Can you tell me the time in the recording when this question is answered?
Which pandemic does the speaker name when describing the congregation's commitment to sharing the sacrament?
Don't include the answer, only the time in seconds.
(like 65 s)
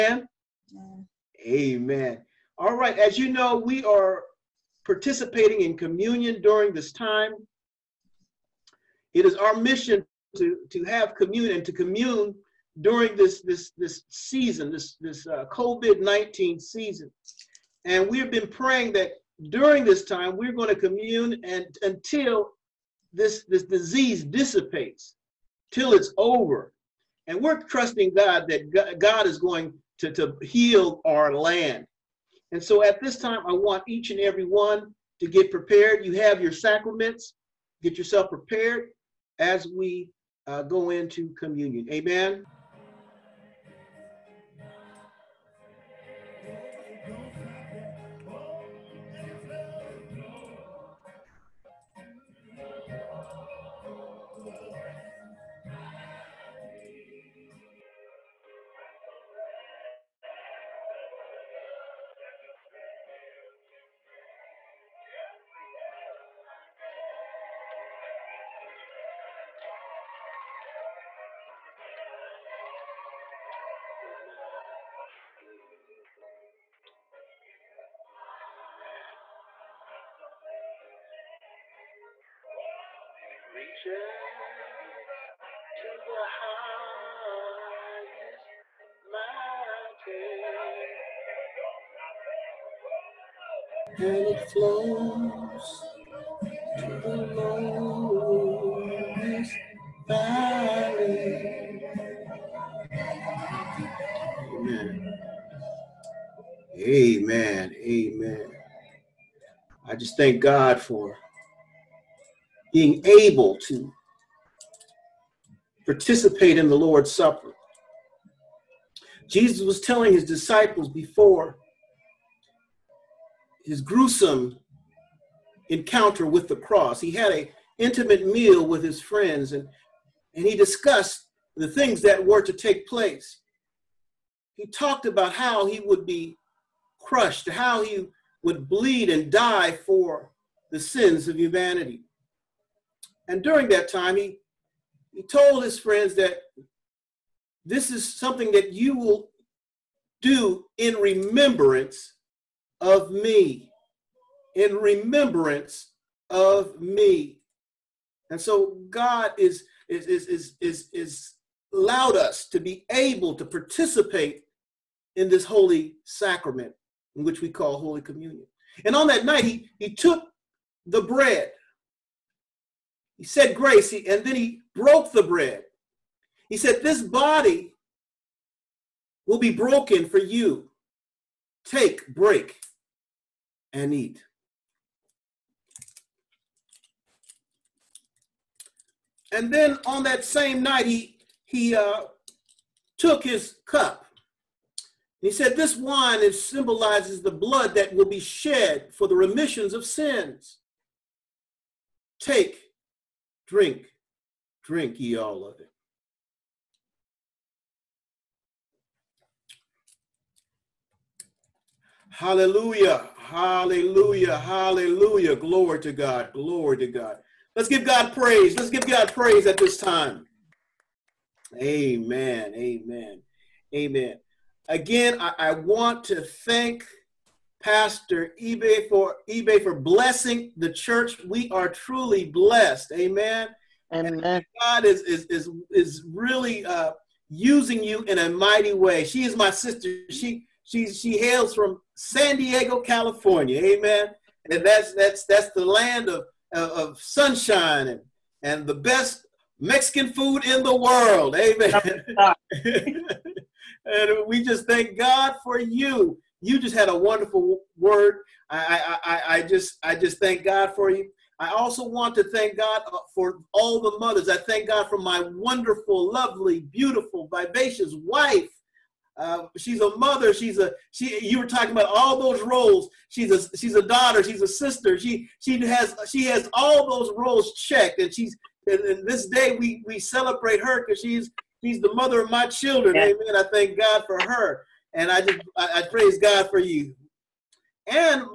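15 s.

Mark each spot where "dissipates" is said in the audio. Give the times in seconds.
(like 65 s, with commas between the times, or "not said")
24 s.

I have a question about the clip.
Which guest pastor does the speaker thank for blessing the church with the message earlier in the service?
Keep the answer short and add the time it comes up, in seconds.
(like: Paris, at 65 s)
Pastor Ibe, at 227 s.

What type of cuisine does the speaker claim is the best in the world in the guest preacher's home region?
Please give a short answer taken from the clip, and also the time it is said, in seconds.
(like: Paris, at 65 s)
Mexican food, at 249 s.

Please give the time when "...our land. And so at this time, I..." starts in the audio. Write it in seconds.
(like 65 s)
31 s.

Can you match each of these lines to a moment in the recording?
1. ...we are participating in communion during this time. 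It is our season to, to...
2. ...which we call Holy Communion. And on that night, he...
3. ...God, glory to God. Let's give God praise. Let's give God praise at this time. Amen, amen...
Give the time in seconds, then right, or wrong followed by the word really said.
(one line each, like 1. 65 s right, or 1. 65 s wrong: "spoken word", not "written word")
1. 3 s wrong: "mission", not "season"
2. 167 s right
3. 215 s right.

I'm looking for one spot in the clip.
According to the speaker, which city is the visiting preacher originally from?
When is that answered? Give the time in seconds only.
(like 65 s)
241 s.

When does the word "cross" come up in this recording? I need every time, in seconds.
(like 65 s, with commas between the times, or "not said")
126 s.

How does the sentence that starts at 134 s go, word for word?
He talked about how he would be crushed, to how he would bleed and die for the sins of humanity.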